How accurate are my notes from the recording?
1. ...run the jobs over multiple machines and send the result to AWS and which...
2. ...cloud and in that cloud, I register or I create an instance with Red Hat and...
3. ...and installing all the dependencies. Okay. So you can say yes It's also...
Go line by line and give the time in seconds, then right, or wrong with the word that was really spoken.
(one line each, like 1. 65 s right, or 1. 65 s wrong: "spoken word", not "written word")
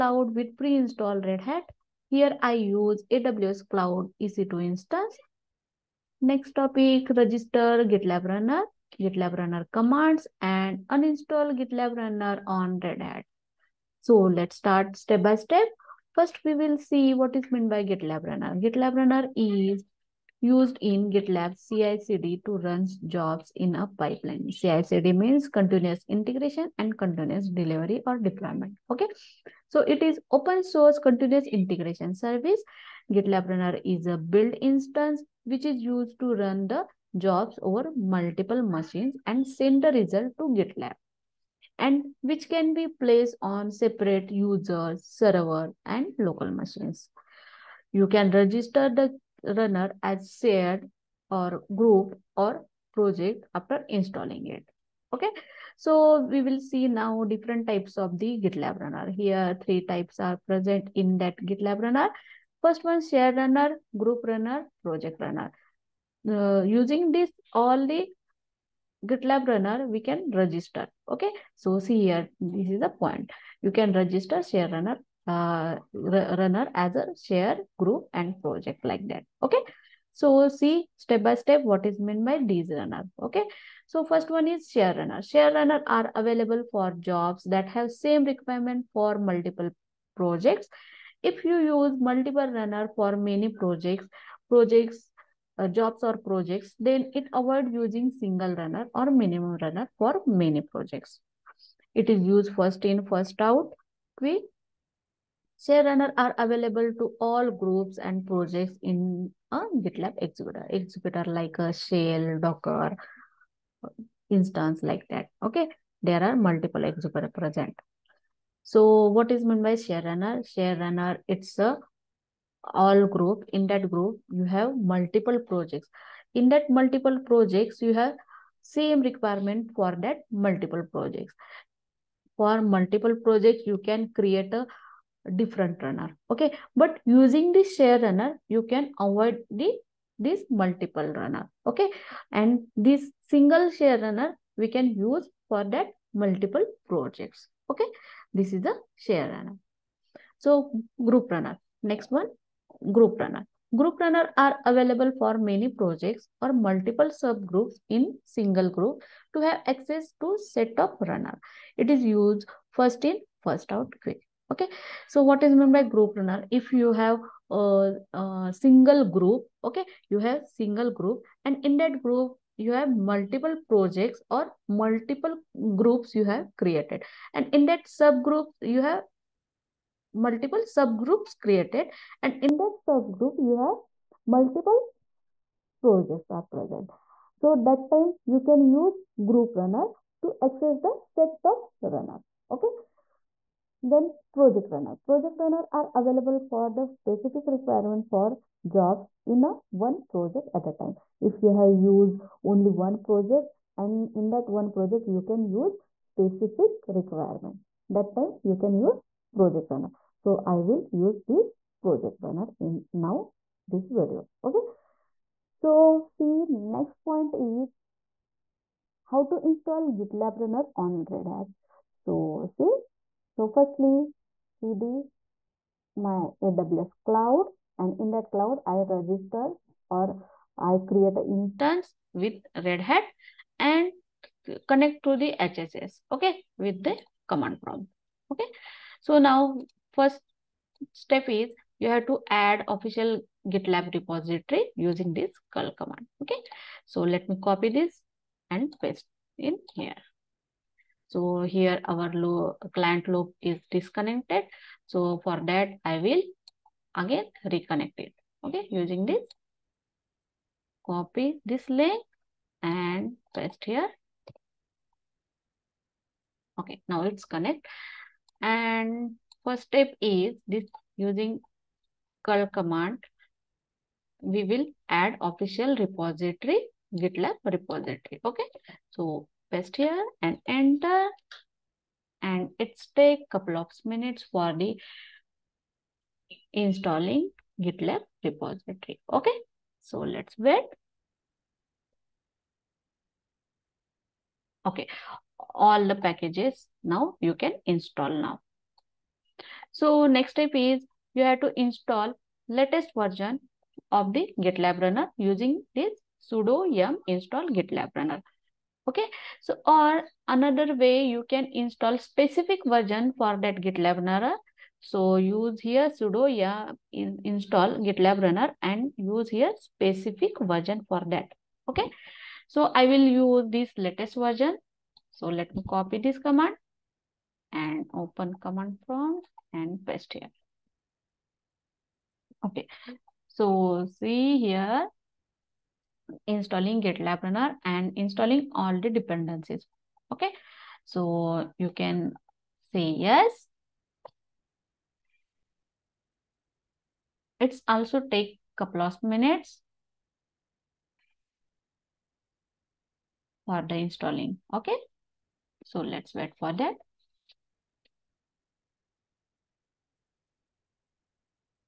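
1. 36 s wrong: "GitLab", not "AWS"
2. 227 s right
3. 337 s right.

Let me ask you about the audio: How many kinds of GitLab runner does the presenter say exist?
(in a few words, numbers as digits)
3.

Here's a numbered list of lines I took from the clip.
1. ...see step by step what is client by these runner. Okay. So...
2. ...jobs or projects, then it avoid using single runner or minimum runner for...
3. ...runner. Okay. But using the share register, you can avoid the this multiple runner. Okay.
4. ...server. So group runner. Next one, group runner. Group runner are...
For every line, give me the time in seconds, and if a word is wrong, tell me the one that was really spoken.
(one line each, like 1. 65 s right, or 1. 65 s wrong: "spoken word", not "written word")
1. 80 s wrong: "meant", not "client"
2. 95 s right
3. 135 s wrong: "runner", not "register"
4. 149 s wrong: "runner", not "server".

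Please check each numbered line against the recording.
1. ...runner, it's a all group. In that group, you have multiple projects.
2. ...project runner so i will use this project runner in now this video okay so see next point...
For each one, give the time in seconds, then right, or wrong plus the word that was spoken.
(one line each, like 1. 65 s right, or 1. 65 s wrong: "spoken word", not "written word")
1. 120 s right
2. 209 s right.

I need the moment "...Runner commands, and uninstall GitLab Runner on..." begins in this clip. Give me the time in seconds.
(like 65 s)
9 s.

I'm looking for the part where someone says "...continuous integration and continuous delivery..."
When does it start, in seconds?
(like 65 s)
25 s.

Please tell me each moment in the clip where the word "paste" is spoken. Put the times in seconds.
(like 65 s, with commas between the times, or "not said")
248 s, 263 s, 279 s, 329 s.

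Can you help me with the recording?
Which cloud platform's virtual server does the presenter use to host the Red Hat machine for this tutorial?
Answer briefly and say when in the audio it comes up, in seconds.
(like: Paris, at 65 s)
AWS Cloud EC2, at 3 s.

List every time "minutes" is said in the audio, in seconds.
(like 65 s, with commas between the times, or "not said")
283 s, 349 s.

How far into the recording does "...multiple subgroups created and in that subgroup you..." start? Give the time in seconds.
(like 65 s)
180 s.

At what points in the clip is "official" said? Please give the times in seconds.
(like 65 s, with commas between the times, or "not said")
242 s, 275 s.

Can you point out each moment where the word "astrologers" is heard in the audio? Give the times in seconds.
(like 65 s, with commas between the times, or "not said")
not said.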